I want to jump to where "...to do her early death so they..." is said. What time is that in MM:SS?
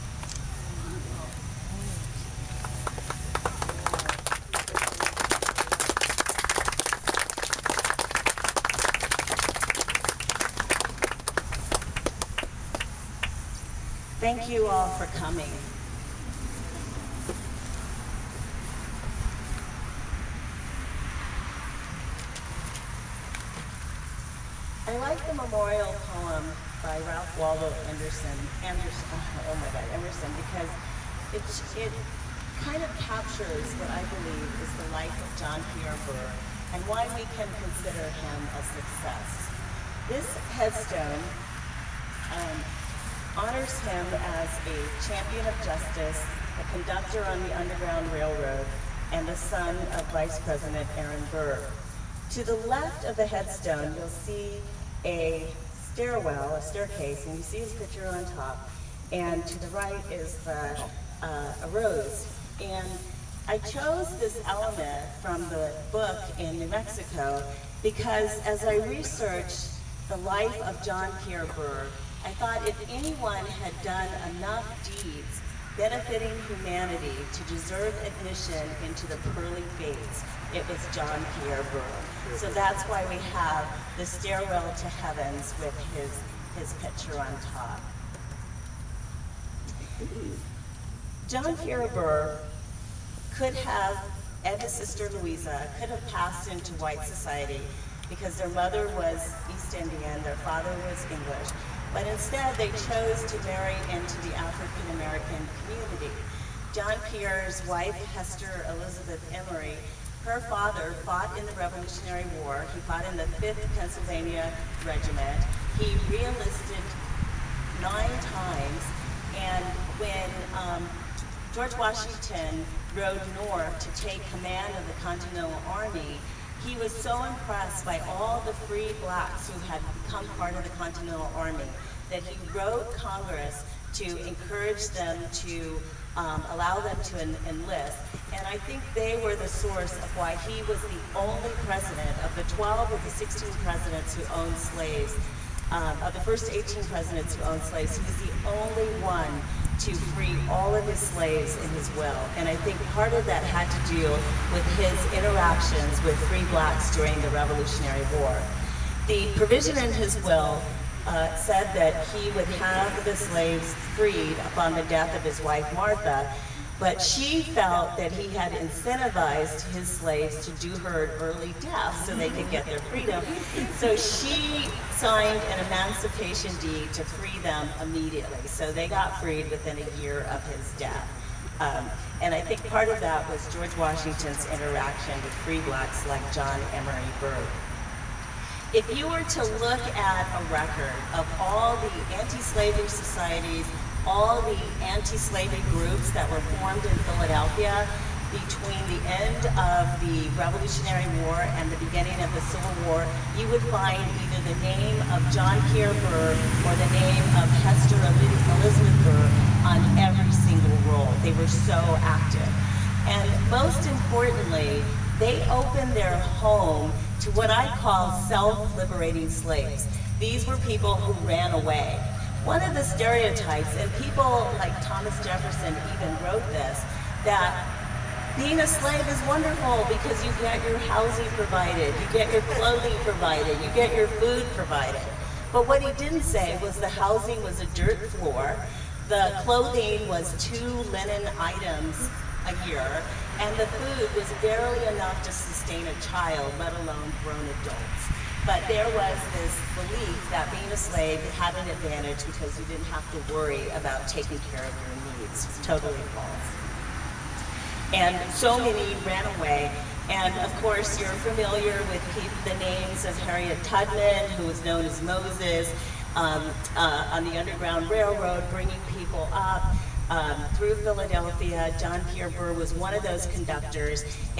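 02:50.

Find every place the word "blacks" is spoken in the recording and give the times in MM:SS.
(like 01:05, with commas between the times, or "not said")
02:09, 02:36, 03:05.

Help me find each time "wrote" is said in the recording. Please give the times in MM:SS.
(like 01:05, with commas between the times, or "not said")
02:12, 03:46.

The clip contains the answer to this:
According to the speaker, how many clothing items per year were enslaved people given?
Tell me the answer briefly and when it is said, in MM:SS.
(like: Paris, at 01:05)
2 linen items, at 04:00.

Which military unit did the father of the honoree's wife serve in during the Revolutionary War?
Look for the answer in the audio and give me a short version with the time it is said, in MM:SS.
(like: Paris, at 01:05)
5th Pennsylvania Regiment, at 01:53.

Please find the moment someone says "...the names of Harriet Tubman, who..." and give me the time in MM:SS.
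04:22.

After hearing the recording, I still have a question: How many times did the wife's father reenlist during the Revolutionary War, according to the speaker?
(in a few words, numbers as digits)
9.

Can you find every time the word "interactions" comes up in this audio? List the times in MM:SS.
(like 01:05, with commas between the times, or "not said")
02:35, 03:04.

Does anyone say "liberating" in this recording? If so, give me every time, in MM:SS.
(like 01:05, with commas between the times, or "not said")
03:38.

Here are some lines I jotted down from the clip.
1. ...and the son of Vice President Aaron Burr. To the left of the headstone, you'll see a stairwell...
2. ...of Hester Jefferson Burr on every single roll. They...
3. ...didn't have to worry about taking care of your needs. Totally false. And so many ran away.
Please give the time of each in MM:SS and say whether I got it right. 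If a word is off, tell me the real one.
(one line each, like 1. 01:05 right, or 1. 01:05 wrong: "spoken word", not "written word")
1. 00:49 right
2. 03:27 wrong: "Elizabeth", not "Jefferson"
3. 04:12 right.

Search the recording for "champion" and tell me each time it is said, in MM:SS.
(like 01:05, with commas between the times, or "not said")
00:45.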